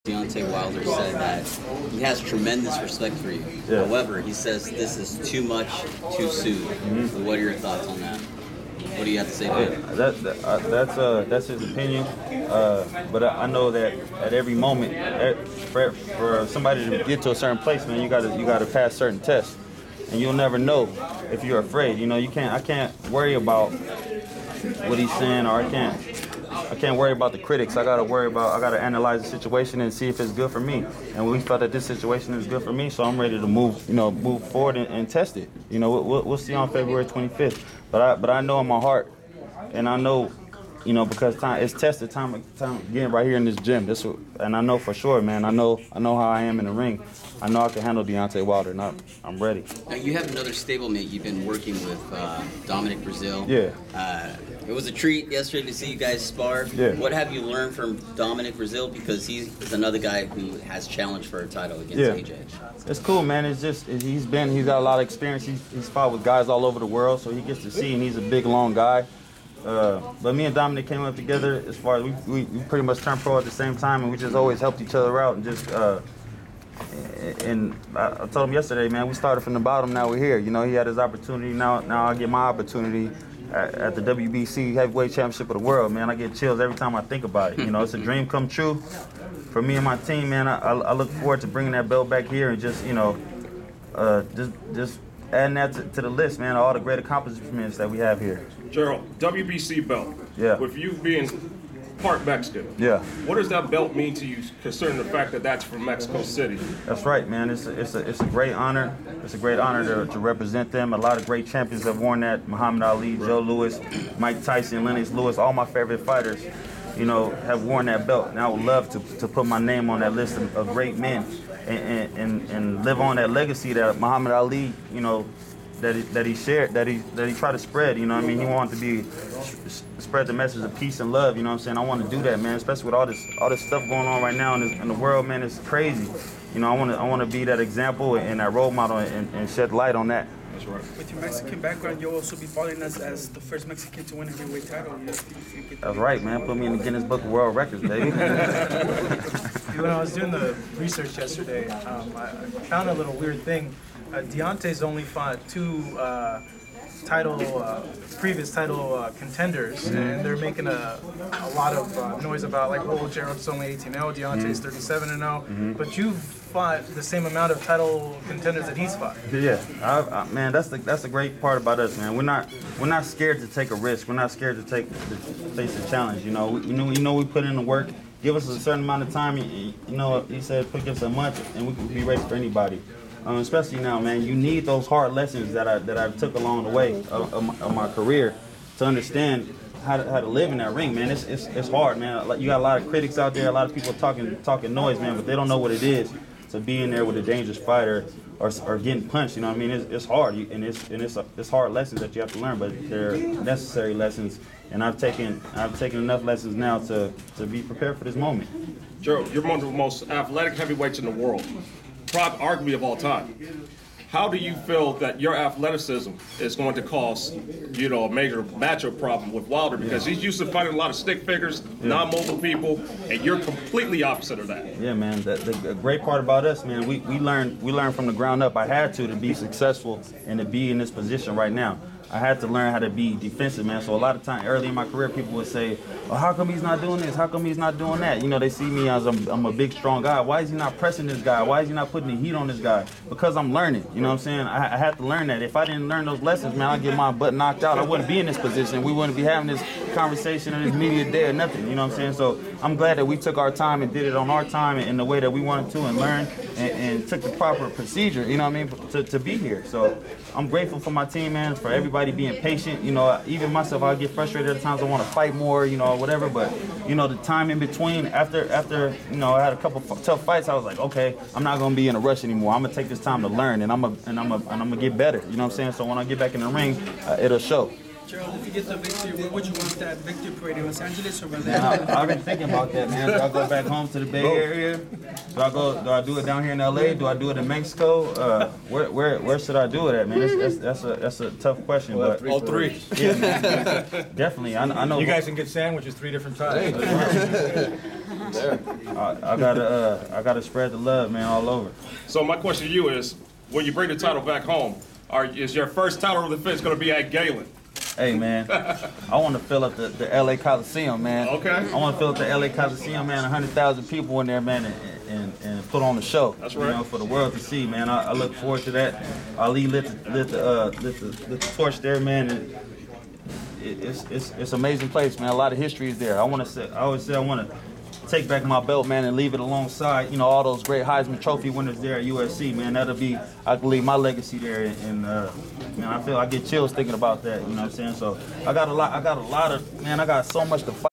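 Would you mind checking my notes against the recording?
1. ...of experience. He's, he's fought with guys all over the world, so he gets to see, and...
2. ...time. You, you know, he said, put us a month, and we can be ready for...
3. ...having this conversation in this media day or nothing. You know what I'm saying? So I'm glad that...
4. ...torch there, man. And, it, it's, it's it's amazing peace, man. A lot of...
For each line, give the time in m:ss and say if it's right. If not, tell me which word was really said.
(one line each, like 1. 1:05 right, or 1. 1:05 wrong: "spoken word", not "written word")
1. 1:04 right
2. 2:59 right
3. 4:09 right
4. 5:21 wrong: "place", not "peace".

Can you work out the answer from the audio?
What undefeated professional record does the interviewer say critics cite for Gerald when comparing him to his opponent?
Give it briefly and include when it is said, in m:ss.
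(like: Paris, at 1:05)
18-0, at 2:43.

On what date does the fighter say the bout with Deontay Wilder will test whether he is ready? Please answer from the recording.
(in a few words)
February 25th.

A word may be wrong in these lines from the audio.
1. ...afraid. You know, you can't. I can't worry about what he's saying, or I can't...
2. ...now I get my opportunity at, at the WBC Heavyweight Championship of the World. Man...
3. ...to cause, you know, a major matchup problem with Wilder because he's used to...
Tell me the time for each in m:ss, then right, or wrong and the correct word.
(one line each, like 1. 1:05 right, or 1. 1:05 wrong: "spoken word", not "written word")
1. 0:21 right
2. 1:21 right
3. 3:36 right.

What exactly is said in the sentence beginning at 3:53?
So a lot of time early in my career, people would say, oh, "How come he's not doing this?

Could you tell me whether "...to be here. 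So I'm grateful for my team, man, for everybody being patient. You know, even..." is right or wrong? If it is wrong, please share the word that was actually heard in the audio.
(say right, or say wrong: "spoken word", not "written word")
right.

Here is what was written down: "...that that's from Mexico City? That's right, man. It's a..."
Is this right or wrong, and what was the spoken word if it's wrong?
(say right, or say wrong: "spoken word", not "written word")
right.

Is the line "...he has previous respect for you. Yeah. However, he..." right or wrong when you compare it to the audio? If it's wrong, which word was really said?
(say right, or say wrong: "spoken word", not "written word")
wrong: "tremendous", not "previous".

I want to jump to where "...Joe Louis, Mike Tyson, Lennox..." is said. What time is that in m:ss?
1:53.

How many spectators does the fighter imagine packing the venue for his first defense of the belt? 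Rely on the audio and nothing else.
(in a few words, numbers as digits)
100,000.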